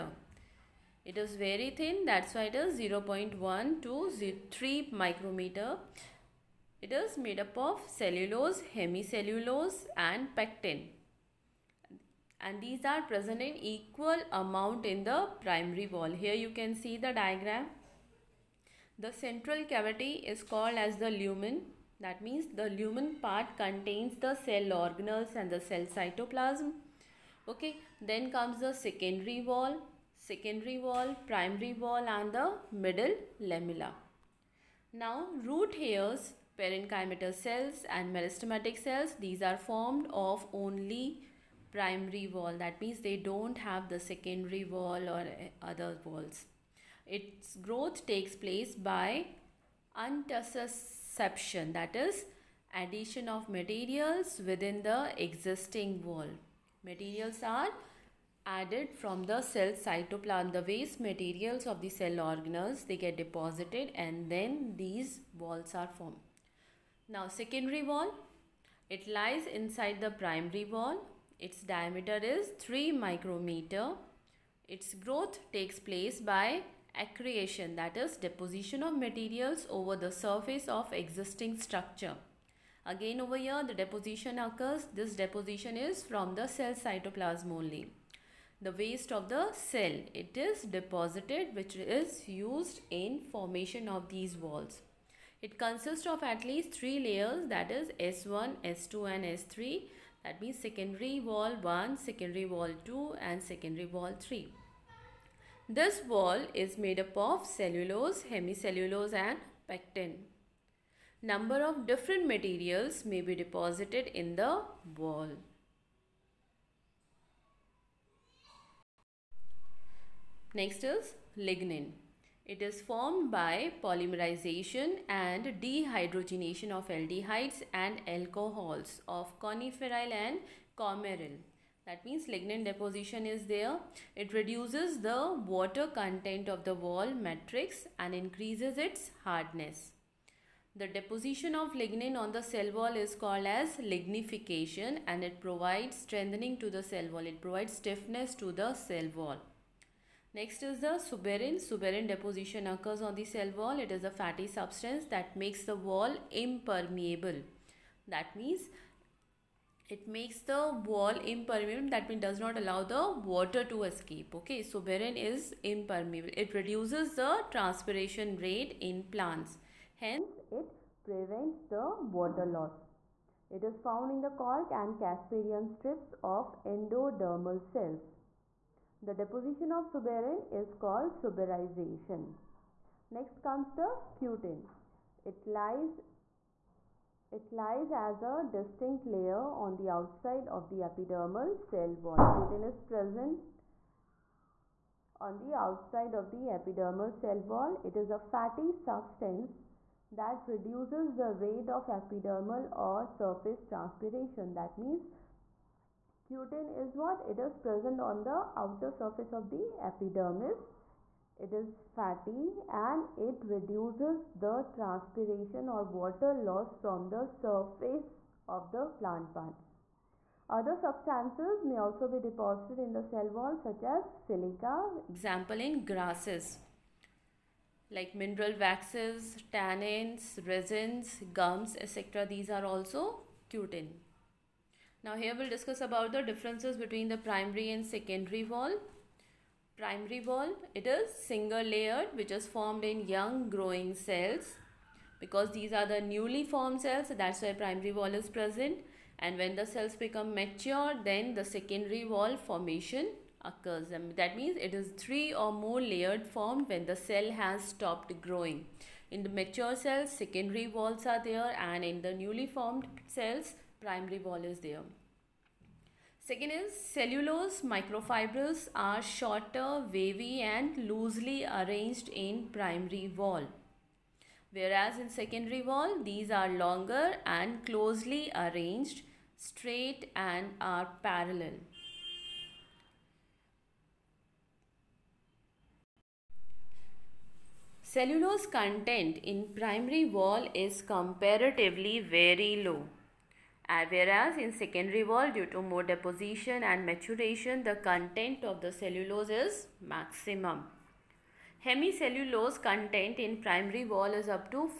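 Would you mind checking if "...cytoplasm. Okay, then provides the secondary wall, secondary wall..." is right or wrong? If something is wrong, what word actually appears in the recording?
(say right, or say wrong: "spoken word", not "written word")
wrong: "comes", not "provides".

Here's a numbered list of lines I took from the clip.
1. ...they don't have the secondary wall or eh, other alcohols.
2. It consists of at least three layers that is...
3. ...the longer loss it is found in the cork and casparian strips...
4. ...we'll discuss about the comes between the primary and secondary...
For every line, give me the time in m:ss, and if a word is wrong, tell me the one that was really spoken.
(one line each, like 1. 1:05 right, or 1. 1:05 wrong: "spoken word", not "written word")
1. 0:42 wrong: "walls", not "alcohols"
2. 1:35 right
3. 2:51 wrong: "water", not "longer"
4. 3:55 wrong: "differences", not "comes".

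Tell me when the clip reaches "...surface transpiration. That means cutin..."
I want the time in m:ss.
3:23.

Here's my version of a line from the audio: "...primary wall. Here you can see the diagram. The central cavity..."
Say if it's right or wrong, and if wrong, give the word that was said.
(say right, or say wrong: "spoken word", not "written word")
right.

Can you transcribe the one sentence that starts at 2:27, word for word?
It provides stiffness to the cell wall.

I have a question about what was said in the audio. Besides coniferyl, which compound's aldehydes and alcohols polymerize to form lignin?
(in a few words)
Coumaryl.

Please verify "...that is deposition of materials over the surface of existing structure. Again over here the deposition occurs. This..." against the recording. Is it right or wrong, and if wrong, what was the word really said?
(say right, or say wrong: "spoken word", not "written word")
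right.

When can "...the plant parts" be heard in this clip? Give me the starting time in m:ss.
3:38.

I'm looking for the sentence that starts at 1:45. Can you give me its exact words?
This wall is made up of cellulose, hemicellulose and pectin.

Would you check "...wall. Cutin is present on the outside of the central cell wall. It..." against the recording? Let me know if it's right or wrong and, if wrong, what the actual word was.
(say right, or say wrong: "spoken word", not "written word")
wrong: "epidermal", not "central".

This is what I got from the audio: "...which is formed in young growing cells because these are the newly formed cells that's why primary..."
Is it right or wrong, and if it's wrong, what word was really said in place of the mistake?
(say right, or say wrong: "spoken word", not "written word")
right.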